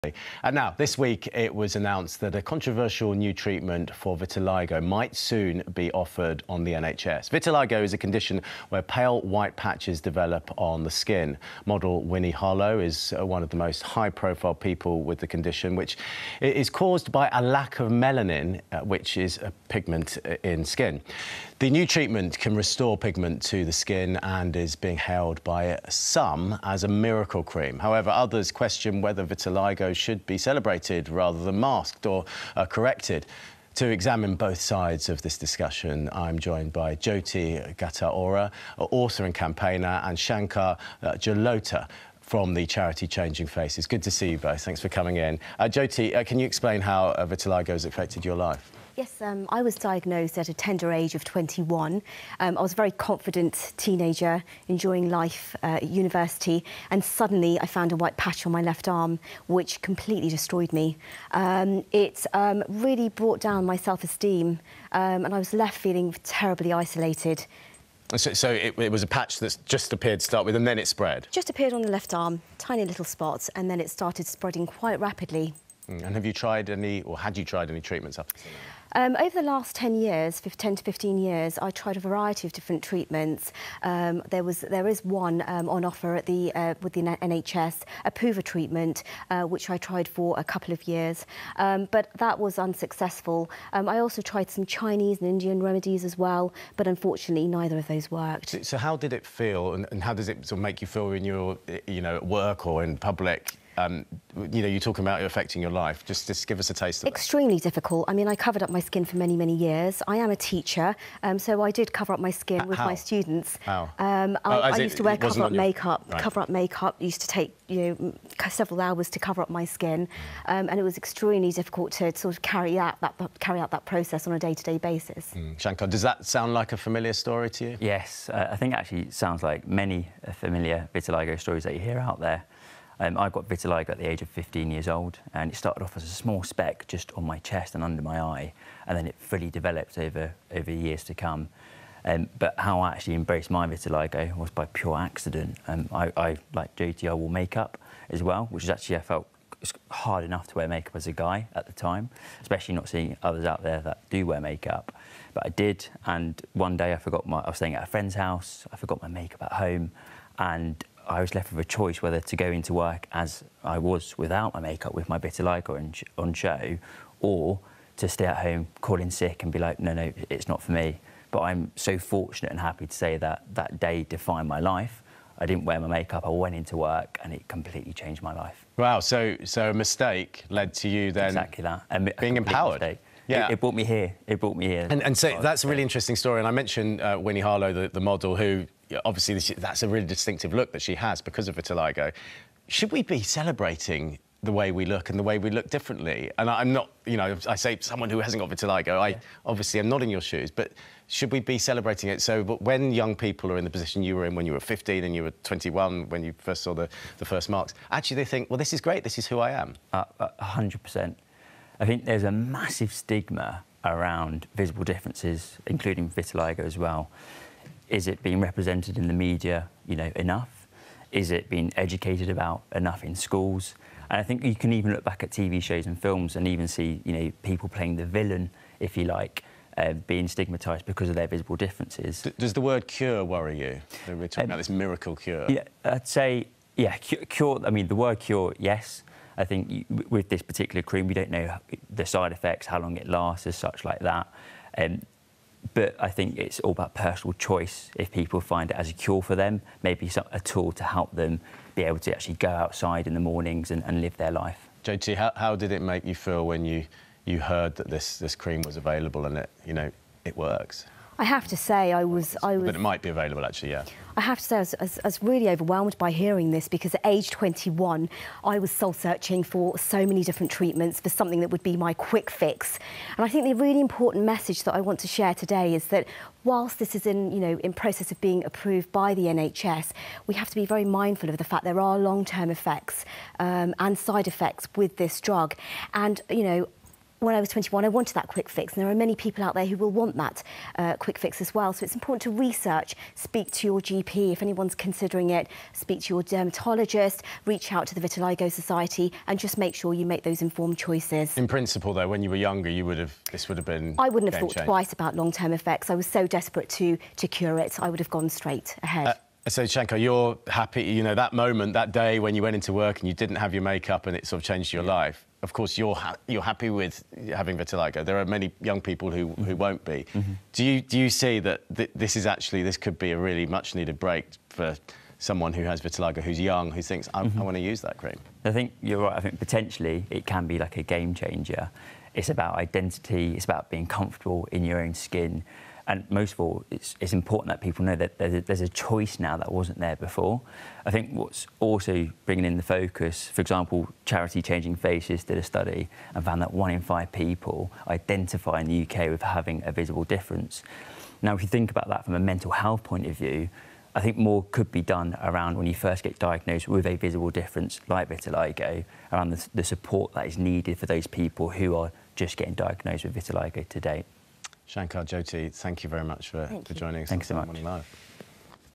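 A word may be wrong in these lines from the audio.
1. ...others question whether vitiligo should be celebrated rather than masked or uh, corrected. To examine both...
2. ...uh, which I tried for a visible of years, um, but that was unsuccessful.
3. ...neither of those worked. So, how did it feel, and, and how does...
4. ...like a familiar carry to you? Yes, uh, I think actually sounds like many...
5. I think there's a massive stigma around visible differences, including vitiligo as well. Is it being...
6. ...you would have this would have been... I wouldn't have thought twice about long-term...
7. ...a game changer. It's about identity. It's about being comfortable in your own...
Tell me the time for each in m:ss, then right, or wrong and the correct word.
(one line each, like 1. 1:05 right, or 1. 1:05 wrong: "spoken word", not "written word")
1. 0:28 right
2. 1:29 wrong: "couple", not "visible"
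3. 1:37 right
4. 2:06 wrong: "story", not "carry"
5. 3:31 right
6. 5:02 right
7. 5:30 right.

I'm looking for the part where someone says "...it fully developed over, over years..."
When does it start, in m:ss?
2:19.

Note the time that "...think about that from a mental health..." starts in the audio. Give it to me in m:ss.
5:51.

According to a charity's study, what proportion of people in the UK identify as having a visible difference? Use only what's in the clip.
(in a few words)
1 in 5.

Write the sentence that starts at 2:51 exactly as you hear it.
But I'm so fortunate and happy to say that that day defined my life.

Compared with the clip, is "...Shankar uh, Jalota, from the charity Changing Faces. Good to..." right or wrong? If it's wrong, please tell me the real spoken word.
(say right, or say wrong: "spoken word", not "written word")
right.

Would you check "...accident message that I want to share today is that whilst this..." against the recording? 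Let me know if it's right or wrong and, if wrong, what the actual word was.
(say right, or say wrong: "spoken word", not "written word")
wrong: "important", not "accident".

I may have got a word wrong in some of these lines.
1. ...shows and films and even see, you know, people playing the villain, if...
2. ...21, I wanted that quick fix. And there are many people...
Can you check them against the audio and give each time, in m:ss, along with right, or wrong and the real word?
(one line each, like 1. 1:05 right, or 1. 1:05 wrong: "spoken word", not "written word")
1. 3:45 right
2. 4:47 right.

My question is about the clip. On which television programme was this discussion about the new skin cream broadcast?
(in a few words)
Morning Live.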